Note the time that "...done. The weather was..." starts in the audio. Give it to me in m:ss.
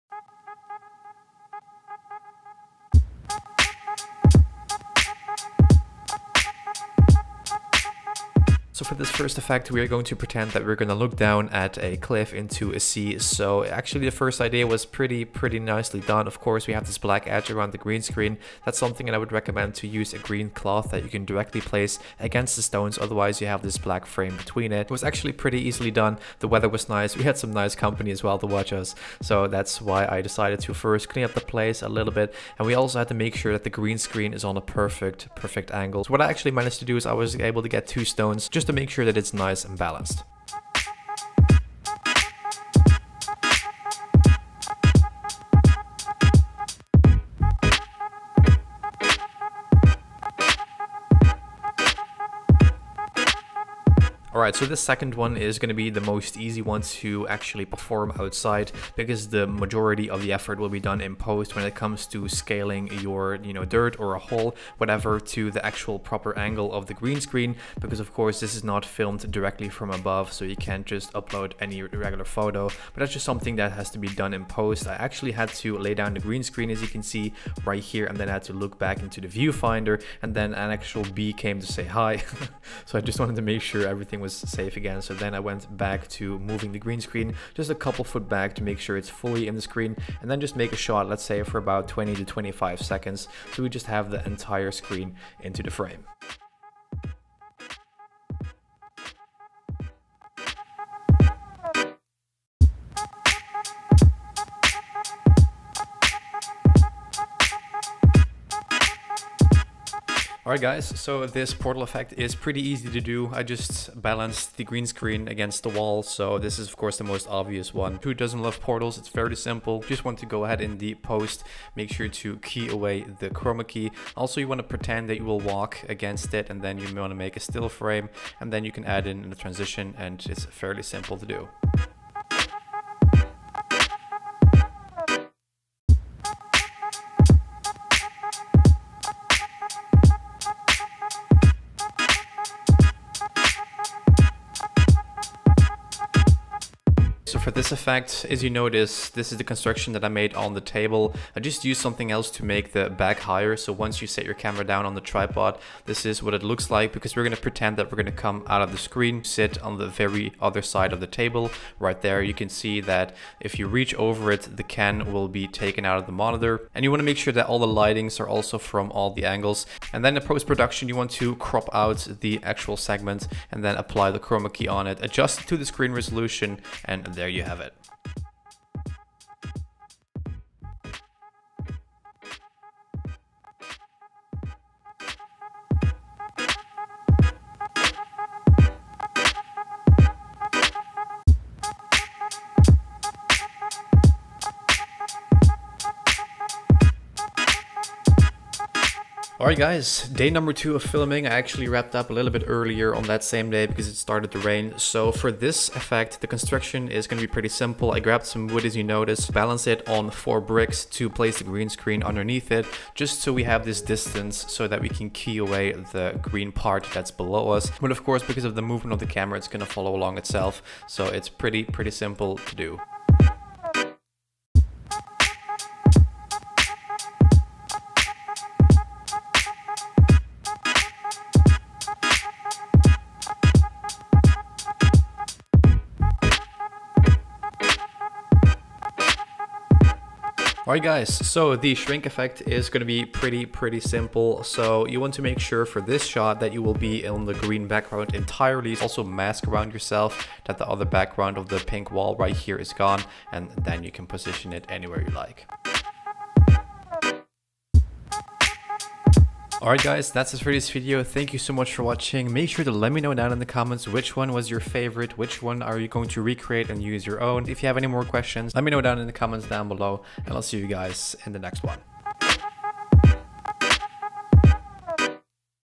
0:25.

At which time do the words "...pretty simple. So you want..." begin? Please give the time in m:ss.
4:03.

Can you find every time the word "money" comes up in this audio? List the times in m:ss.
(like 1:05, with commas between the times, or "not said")
not said.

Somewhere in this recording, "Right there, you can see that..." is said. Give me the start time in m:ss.
2:41.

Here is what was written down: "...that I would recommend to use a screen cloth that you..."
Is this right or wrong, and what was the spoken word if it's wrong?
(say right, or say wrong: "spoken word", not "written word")
wrong: "green", not "screen".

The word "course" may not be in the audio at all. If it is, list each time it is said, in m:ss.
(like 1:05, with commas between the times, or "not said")
0:16, 1:08, 1:56, 3:38.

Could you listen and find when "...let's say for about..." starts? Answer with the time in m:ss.
1:31.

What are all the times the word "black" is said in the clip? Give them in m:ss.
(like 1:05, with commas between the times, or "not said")
0:16, 0:23.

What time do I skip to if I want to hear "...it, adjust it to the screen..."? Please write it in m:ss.
2:54.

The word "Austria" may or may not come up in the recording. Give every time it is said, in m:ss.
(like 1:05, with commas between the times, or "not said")
not said.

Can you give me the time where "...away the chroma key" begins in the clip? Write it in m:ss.
2:02.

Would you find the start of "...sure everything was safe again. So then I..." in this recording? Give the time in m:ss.
1:23.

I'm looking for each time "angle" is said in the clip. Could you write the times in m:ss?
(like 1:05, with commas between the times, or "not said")
0:35, 1:06, 2:49.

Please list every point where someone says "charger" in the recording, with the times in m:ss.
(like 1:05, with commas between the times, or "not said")
not said.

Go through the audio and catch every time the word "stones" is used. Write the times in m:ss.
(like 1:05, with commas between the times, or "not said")
0:22, 0:38.